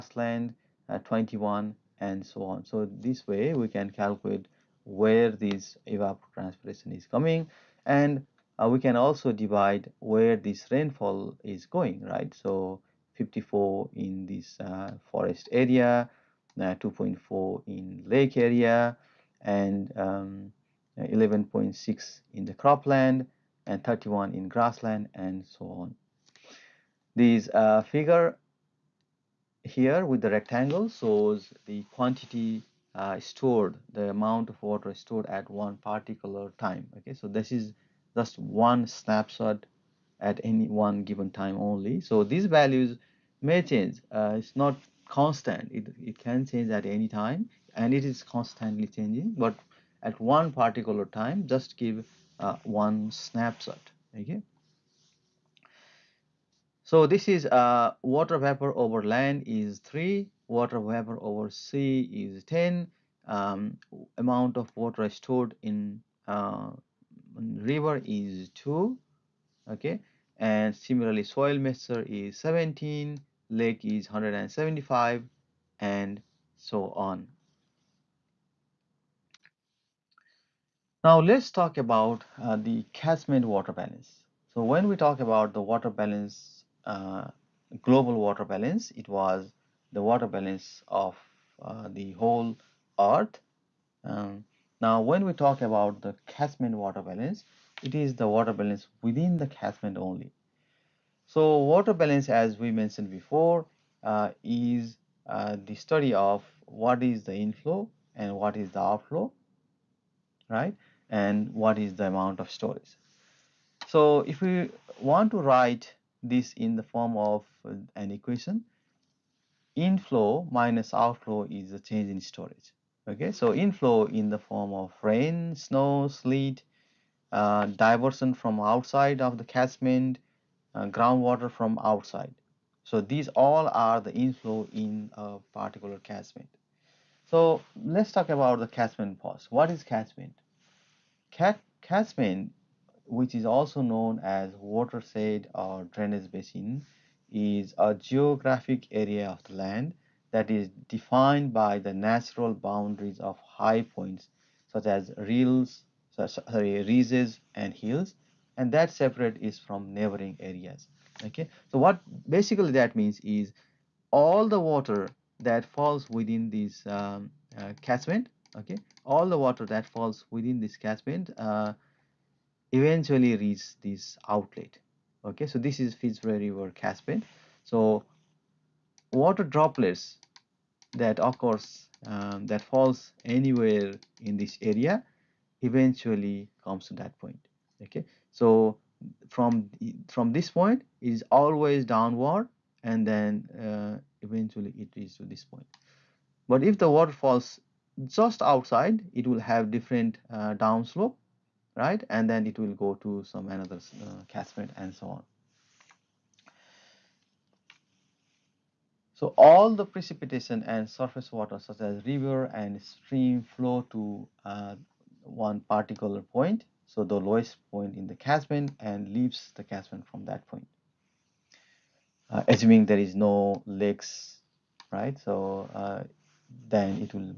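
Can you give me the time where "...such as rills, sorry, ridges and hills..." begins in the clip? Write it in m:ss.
2:34.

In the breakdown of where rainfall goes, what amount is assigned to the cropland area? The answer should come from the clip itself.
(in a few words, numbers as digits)
11.6.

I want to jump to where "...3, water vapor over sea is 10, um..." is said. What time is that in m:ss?
0:59.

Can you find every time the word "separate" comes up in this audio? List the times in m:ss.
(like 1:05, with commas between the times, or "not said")
2:38.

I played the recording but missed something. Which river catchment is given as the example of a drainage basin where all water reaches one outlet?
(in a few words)
Fitzroy River.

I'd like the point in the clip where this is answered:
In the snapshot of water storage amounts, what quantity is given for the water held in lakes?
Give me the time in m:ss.
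1:13.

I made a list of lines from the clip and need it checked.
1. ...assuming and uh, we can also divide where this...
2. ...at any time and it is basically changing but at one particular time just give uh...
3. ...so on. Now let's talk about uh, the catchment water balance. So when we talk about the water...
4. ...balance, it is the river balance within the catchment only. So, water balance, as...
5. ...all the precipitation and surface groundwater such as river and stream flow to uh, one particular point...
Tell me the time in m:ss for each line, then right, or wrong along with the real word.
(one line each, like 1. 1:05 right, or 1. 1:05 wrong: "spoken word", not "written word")
1. 0:07 wrong: "coming", not "assuming"
2. 0:46 wrong: "constantly", not "basically"
3. 1:16 right
4. 1:37 wrong: "water", not "river"
5. 3:29 wrong: "water", not "groundwater".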